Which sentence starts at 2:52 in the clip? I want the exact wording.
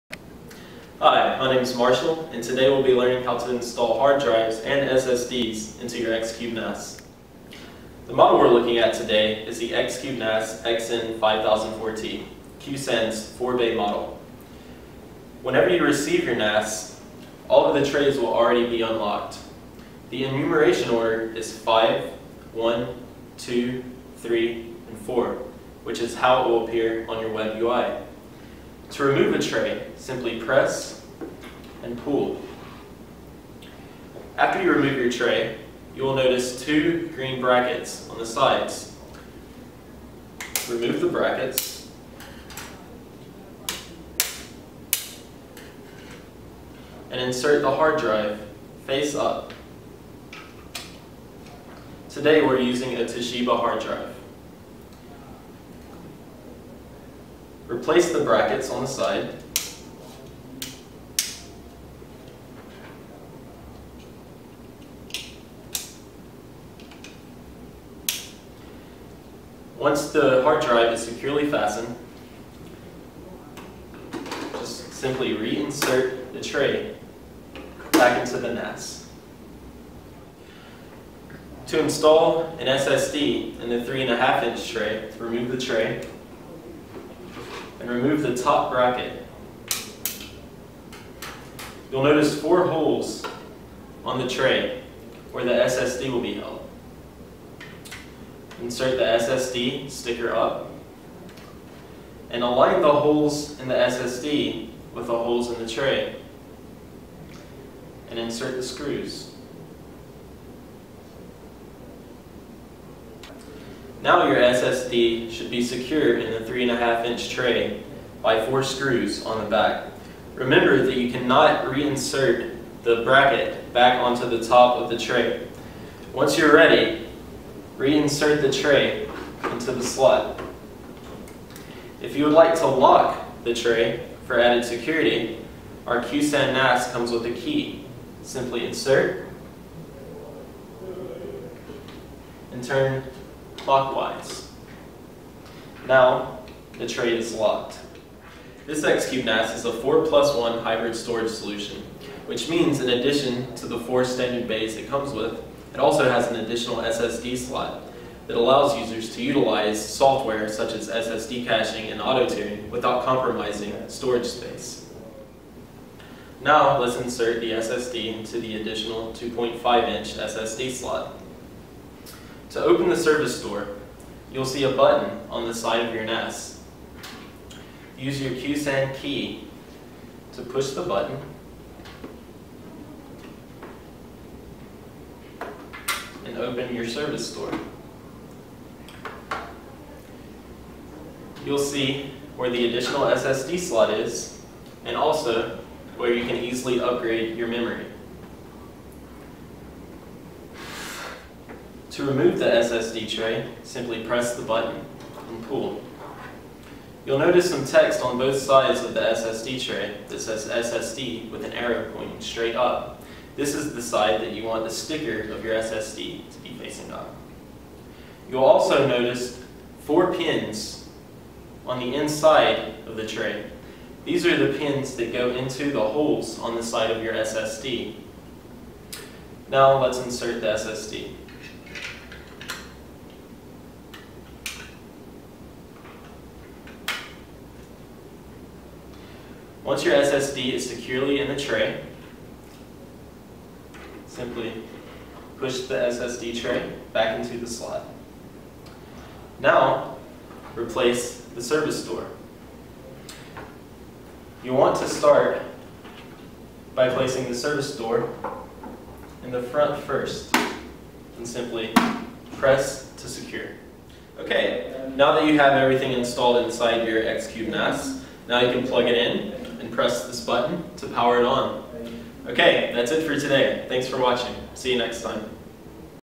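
To open the service door, you'll see a button on the side of your NAS.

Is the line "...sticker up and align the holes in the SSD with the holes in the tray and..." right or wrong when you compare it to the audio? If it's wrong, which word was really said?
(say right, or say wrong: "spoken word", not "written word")
right.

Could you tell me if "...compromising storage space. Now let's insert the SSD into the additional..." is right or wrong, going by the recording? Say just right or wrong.
right.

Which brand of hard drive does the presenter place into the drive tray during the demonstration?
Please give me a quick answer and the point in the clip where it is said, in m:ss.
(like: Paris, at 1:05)
Toshiba, at 0:53.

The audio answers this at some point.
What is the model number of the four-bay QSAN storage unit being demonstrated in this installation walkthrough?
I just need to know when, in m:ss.
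0:10.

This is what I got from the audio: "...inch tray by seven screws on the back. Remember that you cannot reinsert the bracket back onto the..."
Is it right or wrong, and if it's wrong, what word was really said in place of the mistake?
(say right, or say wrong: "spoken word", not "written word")
wrong: "four", not "seven".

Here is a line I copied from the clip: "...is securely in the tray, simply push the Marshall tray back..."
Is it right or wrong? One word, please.
wrong.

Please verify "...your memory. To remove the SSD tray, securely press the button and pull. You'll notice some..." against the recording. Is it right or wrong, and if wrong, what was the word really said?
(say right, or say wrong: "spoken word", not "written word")
wrong: "simply", not "securely".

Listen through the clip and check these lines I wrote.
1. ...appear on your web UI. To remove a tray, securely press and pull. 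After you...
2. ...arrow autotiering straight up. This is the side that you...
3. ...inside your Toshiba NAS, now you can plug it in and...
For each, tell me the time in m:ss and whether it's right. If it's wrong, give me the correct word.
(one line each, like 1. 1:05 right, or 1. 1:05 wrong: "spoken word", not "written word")
1. 0:26 wrong: "simply", not "securely"
2. 3:31 wrong: "pointing", not "autotiering"
3. 4:26 wrong: "Xcube", not "Toshiba".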